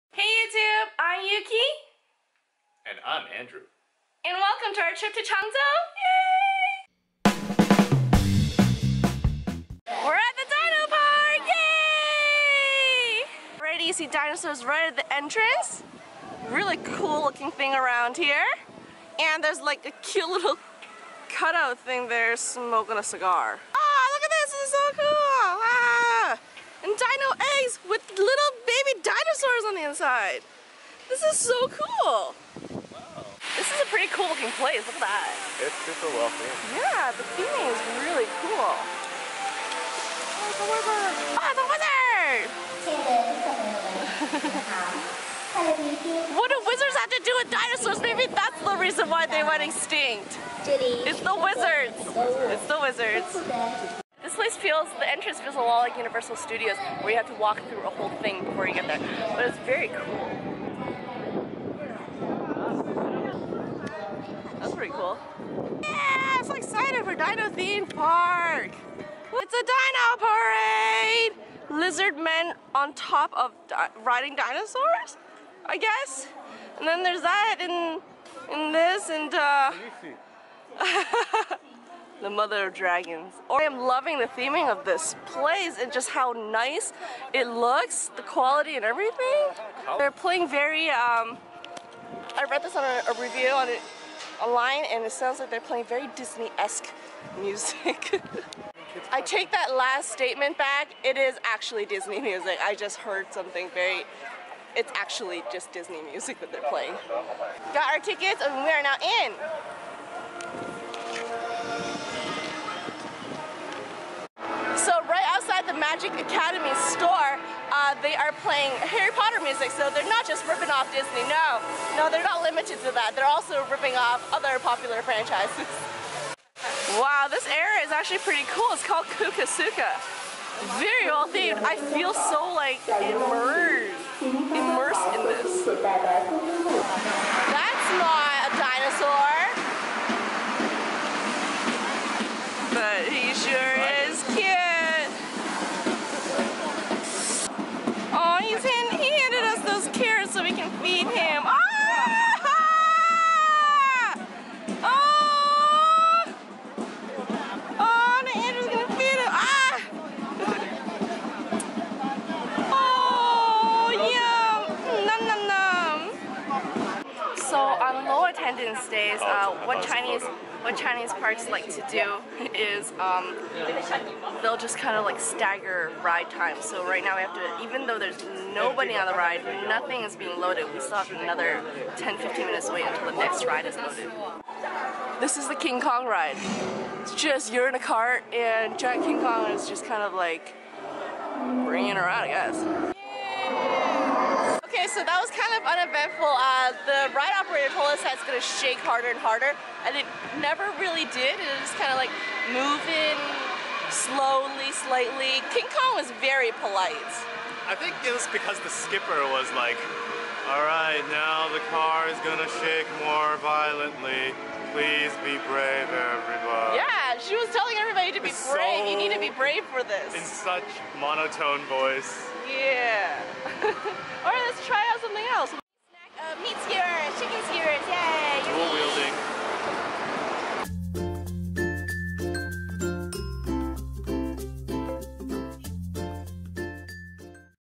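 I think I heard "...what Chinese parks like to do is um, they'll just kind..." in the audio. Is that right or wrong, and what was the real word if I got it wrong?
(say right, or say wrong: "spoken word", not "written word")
right.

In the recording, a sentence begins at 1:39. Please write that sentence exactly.
I take that last statement back.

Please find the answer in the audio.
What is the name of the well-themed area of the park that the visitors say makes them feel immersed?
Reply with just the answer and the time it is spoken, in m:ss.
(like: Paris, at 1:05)
Kukasuka, at 2:09.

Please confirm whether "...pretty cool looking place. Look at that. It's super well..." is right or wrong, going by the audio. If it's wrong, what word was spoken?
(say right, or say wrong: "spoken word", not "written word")
right.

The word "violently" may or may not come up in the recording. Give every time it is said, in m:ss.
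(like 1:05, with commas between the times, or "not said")
3:33.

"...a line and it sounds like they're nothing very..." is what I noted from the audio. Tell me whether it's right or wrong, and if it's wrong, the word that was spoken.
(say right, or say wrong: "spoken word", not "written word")
wrong: "playing", not "nothing".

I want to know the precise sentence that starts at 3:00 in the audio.
We still have another 10-15 minutes to wait until the next ride is loaded.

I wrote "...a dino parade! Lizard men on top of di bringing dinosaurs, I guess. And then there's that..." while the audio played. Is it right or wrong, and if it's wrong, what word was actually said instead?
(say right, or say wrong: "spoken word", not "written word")
wrong: "riding", not "bringing".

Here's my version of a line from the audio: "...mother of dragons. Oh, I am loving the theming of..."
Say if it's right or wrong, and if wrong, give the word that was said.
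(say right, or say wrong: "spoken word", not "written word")
right.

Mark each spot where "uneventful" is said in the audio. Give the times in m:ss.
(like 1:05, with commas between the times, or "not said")
3:15.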